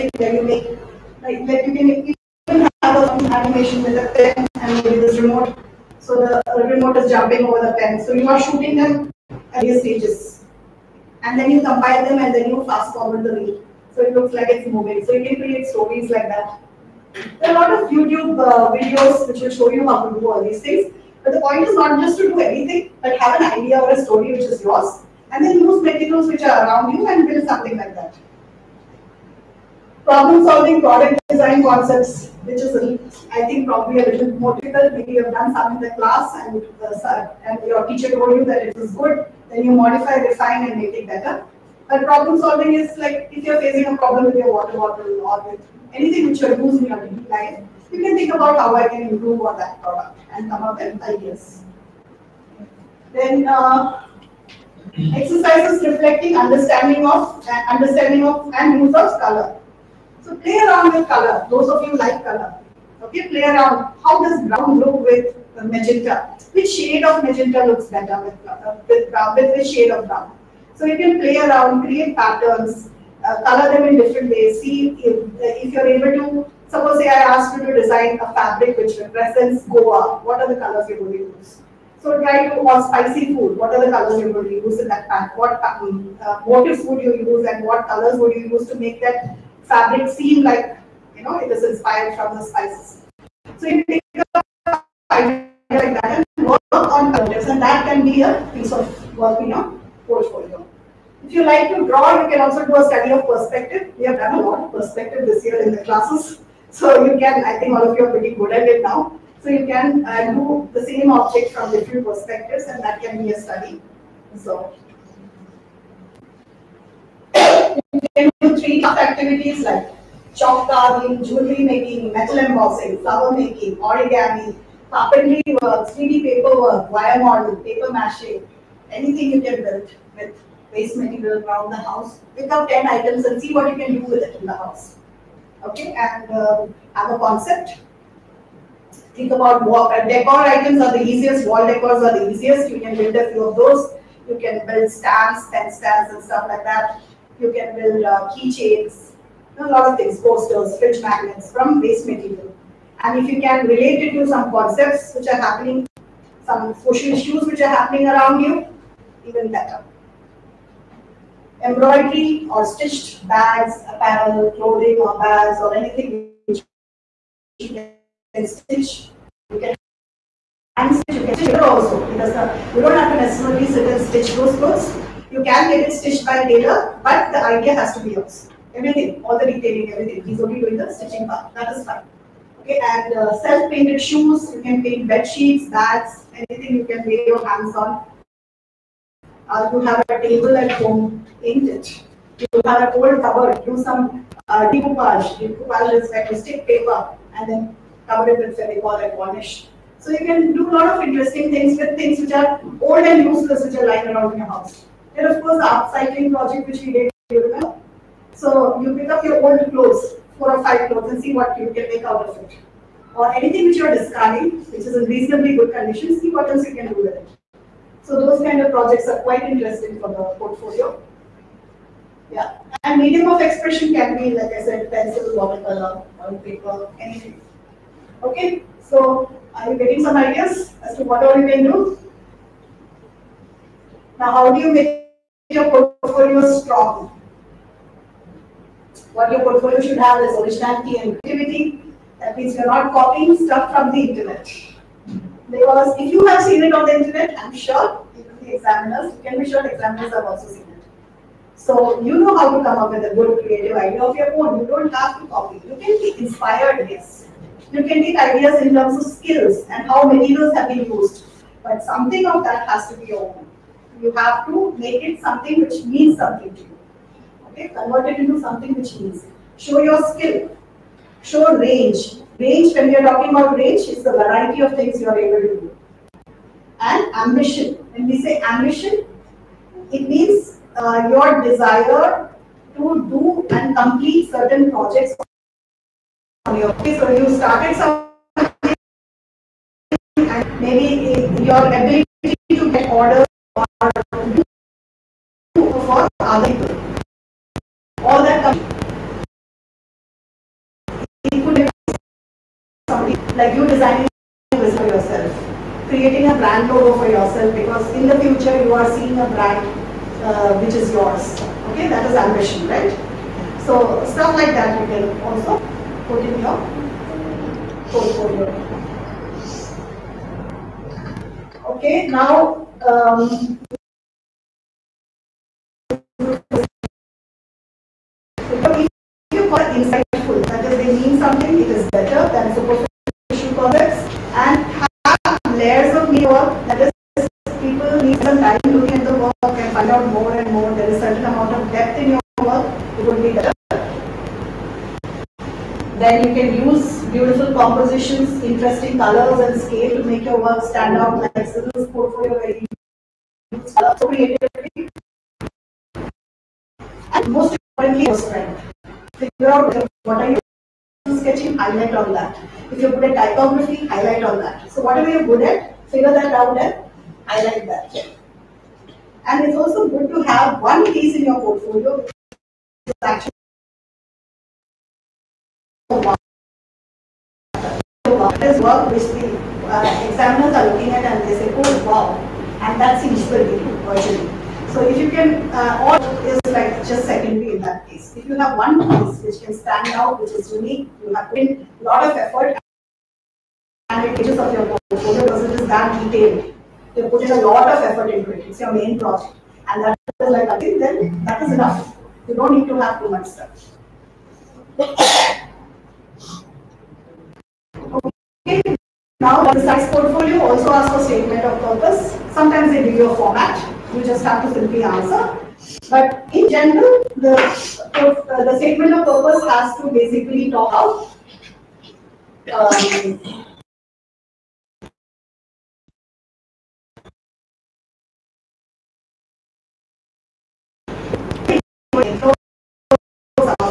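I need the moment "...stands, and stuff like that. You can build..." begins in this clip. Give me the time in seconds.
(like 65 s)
145 s.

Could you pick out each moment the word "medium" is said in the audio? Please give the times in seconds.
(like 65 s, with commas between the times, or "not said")
223 s.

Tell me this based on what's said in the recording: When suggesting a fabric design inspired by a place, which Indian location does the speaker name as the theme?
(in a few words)
Goa.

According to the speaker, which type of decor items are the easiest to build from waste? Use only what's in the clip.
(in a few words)
Wall decors.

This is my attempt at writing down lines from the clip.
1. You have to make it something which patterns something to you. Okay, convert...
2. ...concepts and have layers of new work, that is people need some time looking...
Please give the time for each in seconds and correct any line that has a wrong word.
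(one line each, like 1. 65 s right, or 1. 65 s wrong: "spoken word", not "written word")
1. 264 s wrong: "means", not "patterns"
2. 333 s right.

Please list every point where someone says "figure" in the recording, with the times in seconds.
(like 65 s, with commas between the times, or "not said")
359 s, 365 s.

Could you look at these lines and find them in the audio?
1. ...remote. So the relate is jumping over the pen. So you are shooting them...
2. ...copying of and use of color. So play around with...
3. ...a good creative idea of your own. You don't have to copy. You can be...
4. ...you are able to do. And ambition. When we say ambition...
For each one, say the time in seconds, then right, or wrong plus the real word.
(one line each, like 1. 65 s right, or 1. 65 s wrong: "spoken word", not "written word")
1. 5 s wrong: "remote", not "relate"
2. 57 s wrong: "understanding", not "copying"
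3. 253 s right
4. 275 s right.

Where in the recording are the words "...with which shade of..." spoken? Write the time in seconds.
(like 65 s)
69 s.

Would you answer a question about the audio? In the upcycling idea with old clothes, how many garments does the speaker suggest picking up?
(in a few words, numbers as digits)
4 or 5.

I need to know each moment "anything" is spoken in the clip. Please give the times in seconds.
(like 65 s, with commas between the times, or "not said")
22 s, 45 s, 128 s, 165 s, 186 s, 213 s, 227 s.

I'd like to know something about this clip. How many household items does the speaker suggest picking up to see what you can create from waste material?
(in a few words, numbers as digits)
10.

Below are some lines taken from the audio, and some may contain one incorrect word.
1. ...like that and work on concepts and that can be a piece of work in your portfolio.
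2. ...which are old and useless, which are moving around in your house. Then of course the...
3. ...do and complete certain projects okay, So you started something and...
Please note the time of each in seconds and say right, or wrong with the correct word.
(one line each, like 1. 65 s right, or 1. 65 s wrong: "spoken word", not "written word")
1. 95 s wrong: "projects", not "concepts"
2. 202 s wrong: "lying", not "moving"
3. 283 s right.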